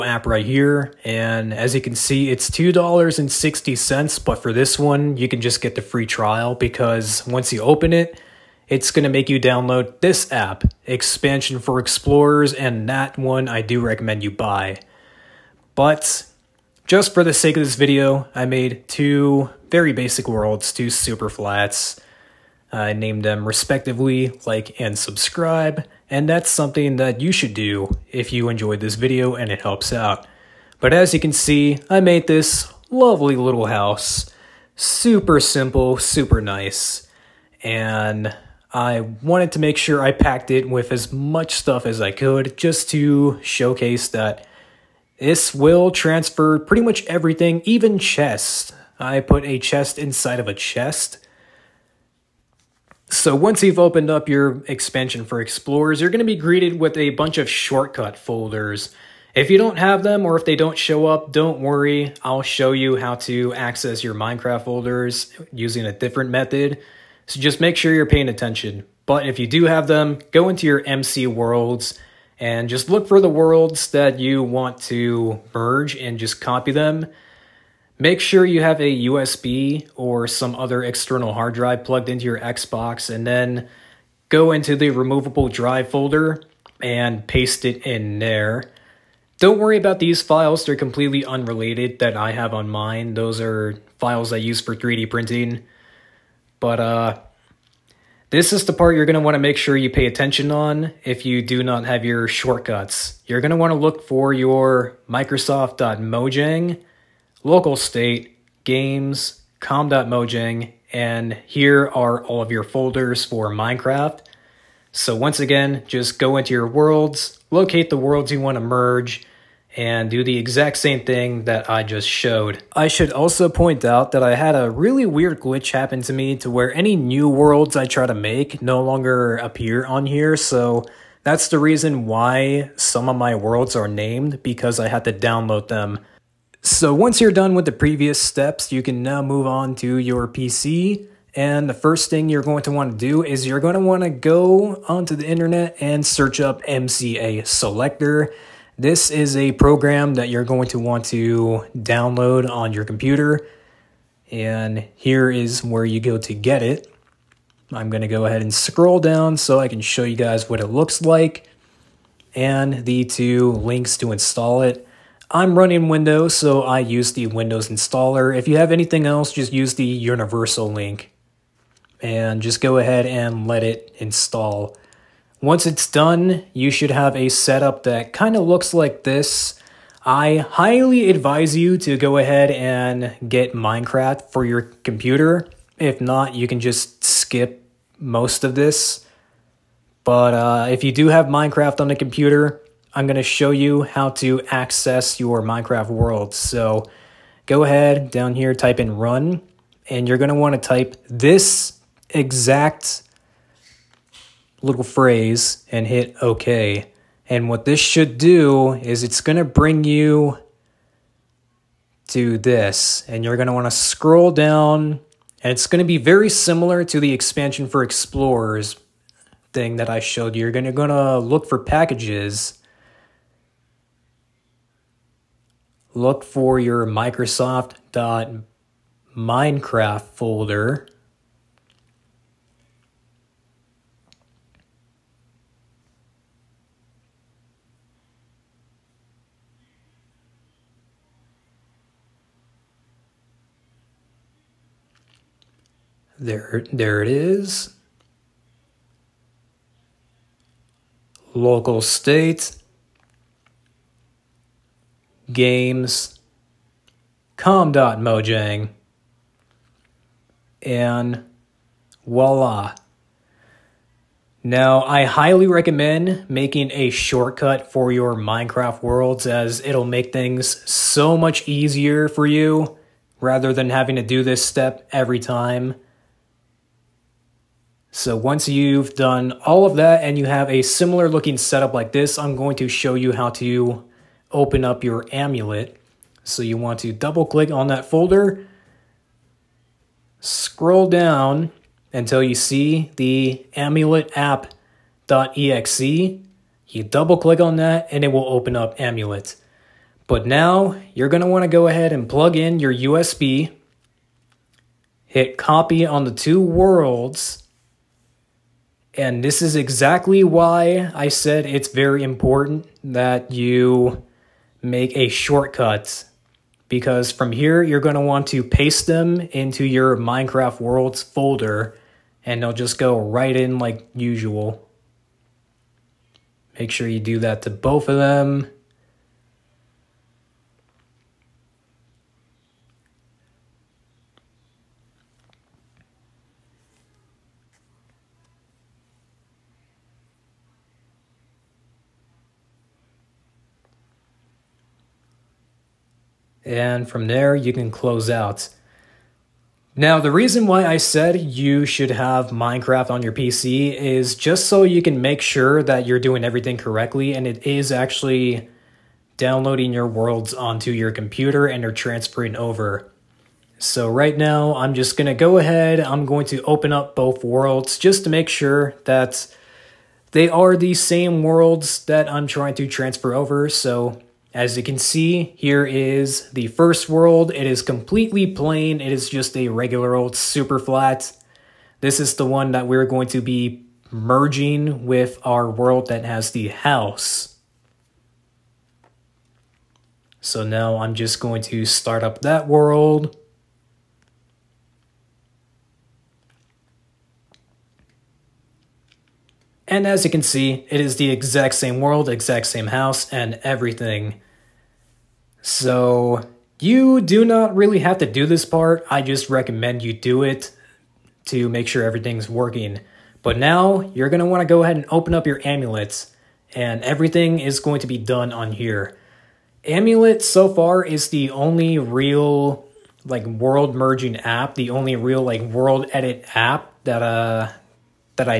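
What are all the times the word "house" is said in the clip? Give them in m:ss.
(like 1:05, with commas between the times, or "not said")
0:33, 6:26, 6:42.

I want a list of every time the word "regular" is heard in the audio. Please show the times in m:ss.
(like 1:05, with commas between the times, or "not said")
6:19.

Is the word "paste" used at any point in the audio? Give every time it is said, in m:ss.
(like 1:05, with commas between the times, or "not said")
1:27, 5:18.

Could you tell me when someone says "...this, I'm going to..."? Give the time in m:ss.
4:41.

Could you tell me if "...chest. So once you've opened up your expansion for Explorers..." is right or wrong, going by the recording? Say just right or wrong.
right.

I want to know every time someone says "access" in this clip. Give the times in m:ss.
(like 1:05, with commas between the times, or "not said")
1:03, 3:14.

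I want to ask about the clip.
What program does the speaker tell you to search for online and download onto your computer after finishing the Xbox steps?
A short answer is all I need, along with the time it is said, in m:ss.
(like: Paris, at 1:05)
MCA Selector, at 2:26.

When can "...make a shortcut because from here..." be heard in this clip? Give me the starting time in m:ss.
5:14.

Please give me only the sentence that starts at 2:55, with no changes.
Once it's done, you should have a setup that kind of looks like this.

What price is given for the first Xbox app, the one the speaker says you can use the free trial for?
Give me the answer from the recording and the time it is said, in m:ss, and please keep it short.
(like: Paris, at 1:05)
$2.60, at 0:02.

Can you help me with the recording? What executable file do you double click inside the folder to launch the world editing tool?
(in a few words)
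amulet app.exe.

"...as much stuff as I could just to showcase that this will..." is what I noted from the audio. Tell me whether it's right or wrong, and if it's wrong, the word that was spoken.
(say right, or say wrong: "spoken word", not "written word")
right.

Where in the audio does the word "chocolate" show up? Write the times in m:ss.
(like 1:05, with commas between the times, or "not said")
not said.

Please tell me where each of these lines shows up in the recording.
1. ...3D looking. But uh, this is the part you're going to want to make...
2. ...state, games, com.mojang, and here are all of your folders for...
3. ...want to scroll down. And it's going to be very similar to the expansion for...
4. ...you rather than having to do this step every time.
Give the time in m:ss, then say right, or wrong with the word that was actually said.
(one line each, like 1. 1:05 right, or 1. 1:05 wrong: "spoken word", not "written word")
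1. 1:34 wrong: "printing", not "looking"
2. 1:47 right
3. 3:33 right
4. 4:32 right.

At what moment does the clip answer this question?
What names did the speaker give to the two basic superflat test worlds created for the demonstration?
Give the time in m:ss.
0:24.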